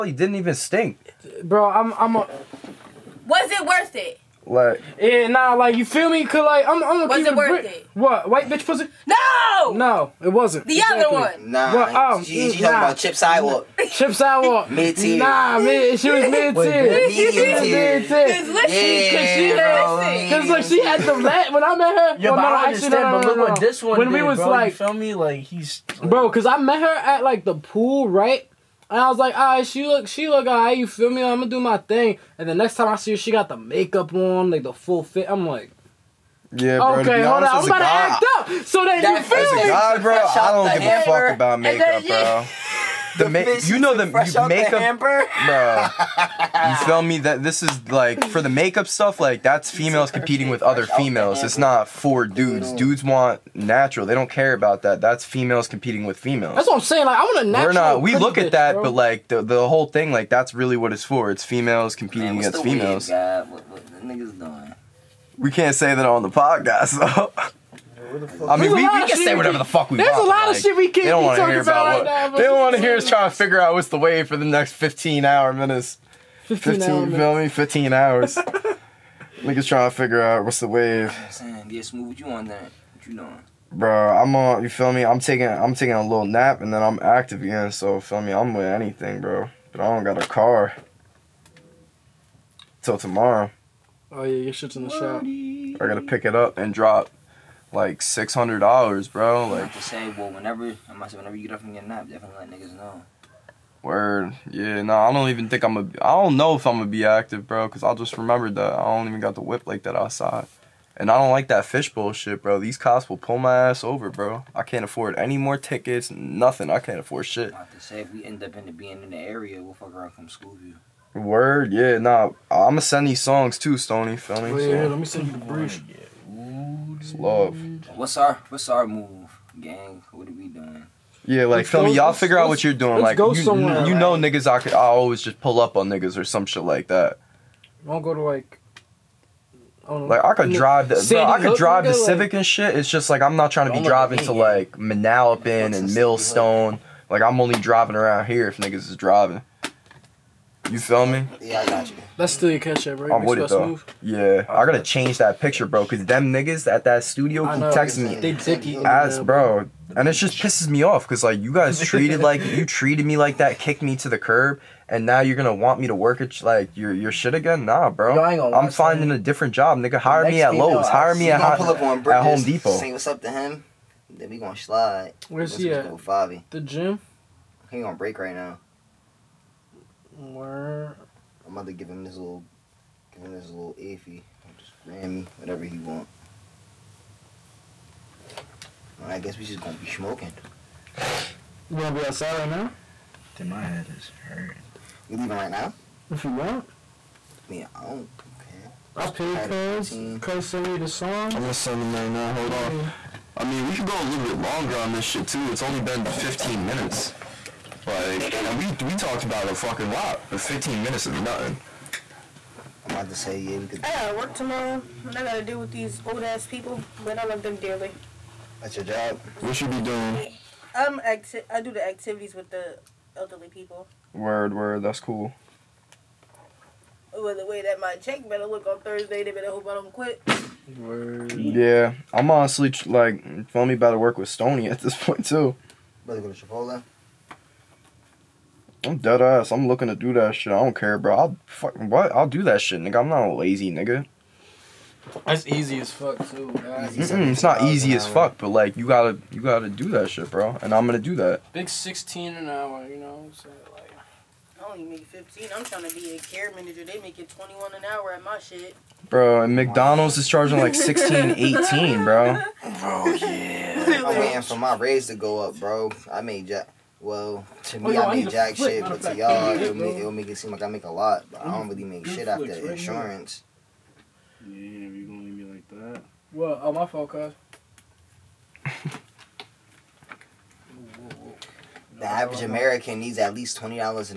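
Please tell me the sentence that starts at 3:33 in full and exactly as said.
I gotta work tomorrow, and I gotta deal with these old ass people, but I love them dearly.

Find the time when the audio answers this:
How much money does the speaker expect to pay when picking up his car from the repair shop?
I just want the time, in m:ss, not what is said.
1:38.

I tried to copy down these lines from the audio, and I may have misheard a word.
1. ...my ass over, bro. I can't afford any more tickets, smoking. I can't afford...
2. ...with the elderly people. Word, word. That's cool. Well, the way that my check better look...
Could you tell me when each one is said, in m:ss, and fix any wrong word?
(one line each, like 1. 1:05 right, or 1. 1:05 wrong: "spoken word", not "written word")
1. 1:53 wrong: "nothing", not "smoking"
2. 3:42 right.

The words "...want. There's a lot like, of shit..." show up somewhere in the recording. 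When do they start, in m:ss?
1:10.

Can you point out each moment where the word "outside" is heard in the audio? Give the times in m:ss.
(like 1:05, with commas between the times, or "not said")
1:49, 3:12.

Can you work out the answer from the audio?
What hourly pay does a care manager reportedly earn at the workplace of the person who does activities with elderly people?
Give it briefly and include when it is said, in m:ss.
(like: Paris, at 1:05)
$21 an hour, at 4:17.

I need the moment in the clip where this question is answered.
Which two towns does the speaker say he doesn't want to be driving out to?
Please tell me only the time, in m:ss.
2:24.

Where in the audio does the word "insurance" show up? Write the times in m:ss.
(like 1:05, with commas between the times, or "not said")
4:32.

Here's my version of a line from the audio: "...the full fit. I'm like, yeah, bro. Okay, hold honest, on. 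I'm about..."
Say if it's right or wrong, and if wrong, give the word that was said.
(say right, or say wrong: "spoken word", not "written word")
right.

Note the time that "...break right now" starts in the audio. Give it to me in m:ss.
2:57.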